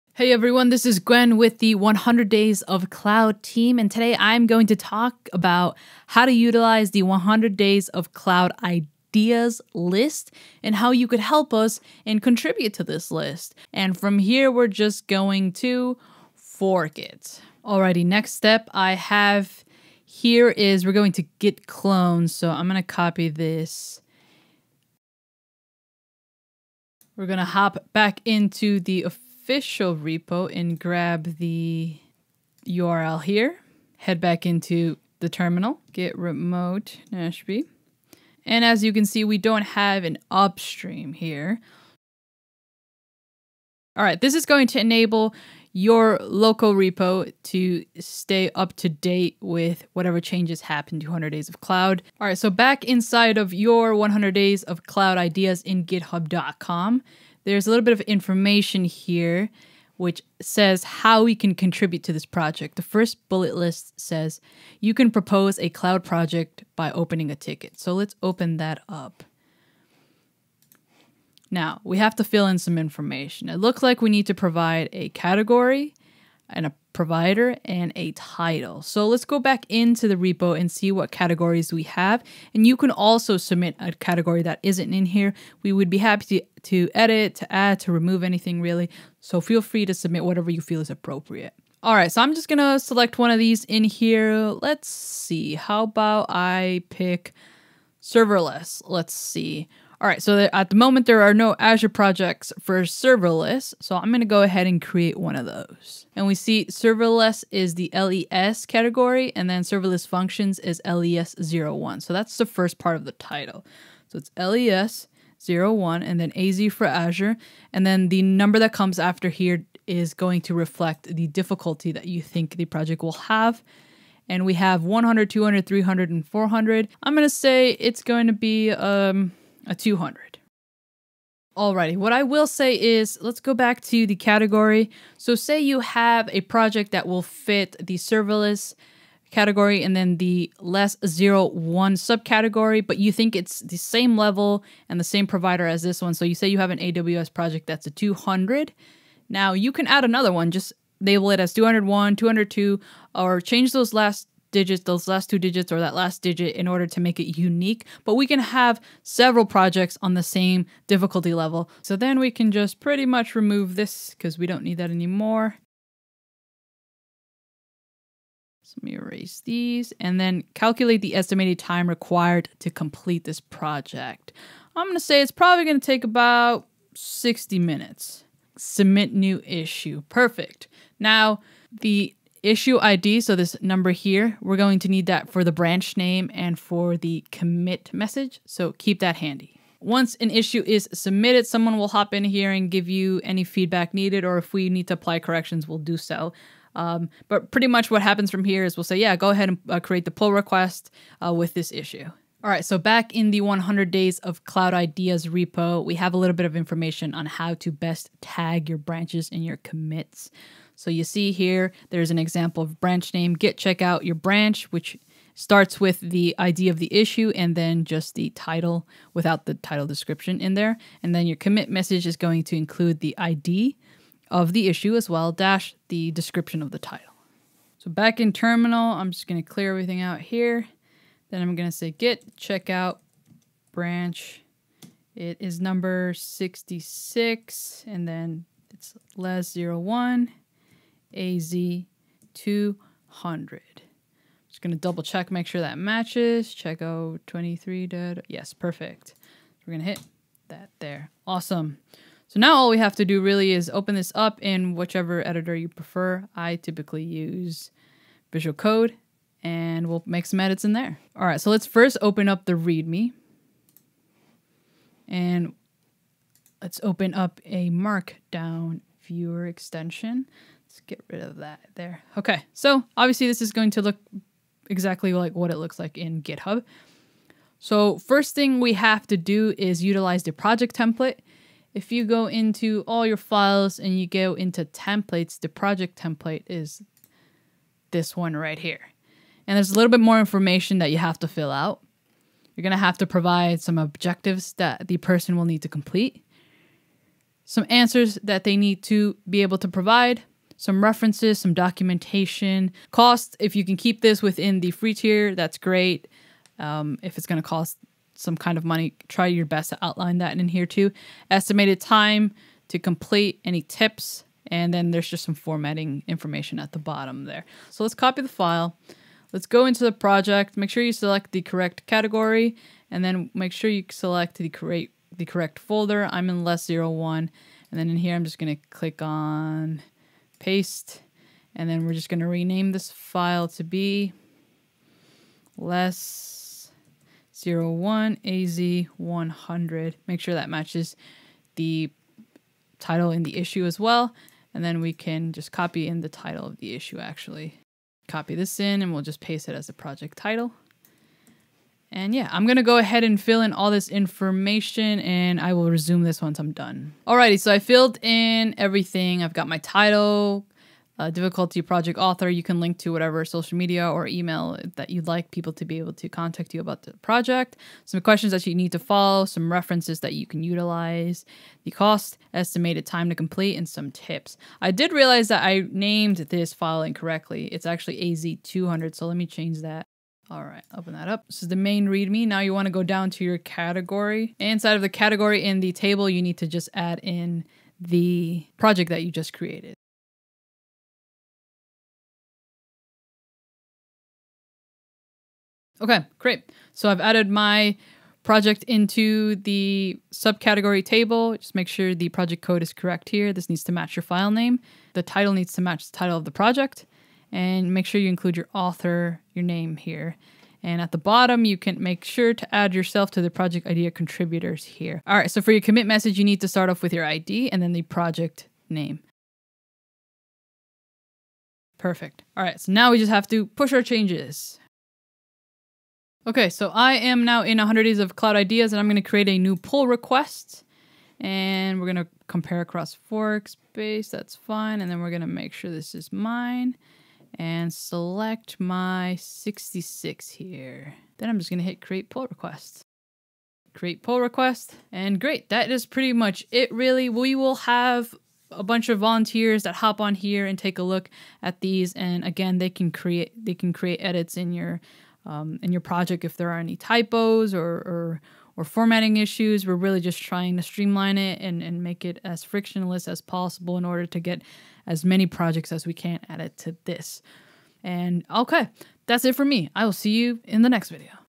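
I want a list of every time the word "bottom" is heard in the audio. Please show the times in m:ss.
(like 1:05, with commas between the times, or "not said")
5:16, 6:50.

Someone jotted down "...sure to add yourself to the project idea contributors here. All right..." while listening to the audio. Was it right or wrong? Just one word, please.
right.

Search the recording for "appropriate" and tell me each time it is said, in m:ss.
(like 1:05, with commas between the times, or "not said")
1:30.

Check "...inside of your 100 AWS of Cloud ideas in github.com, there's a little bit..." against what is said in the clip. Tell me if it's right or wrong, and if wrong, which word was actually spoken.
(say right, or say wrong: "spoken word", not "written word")
wrong: "Days", not "AWS".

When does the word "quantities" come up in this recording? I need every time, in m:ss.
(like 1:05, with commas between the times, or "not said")
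not said.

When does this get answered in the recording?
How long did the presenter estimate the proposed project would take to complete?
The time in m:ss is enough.
2:56.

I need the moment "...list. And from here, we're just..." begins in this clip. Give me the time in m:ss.
0:13.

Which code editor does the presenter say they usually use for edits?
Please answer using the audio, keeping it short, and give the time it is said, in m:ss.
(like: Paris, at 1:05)
Visual Code, at 4:18.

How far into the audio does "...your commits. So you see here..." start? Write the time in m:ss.
3:29.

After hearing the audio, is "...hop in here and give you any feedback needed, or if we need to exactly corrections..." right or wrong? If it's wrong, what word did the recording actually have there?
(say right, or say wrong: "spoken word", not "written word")
wrong: "apply", not "exactly".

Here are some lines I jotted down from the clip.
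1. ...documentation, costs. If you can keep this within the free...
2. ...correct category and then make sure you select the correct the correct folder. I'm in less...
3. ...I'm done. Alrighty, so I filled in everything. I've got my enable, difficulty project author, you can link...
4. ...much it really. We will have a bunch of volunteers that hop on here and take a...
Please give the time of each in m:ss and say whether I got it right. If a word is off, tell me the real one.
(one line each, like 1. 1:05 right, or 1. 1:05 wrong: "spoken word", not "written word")
1. 5:01 right
2. 5:21 right
3. 5:56 wrong: "title", not "enable"
4. 7:26 right.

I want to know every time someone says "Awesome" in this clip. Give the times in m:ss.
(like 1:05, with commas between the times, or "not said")
4:11.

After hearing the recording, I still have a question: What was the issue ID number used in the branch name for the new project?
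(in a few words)
66.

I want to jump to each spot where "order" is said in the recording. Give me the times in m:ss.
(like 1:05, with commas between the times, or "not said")
2:36, 7:43.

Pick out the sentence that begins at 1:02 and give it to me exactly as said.
The first bullet list says you can propose a cloud project by opening a ticket.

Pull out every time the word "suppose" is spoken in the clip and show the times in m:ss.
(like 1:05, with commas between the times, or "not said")
not said.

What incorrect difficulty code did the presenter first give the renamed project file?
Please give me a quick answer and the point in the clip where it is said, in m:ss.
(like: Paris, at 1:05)
AZ100, at 5:38.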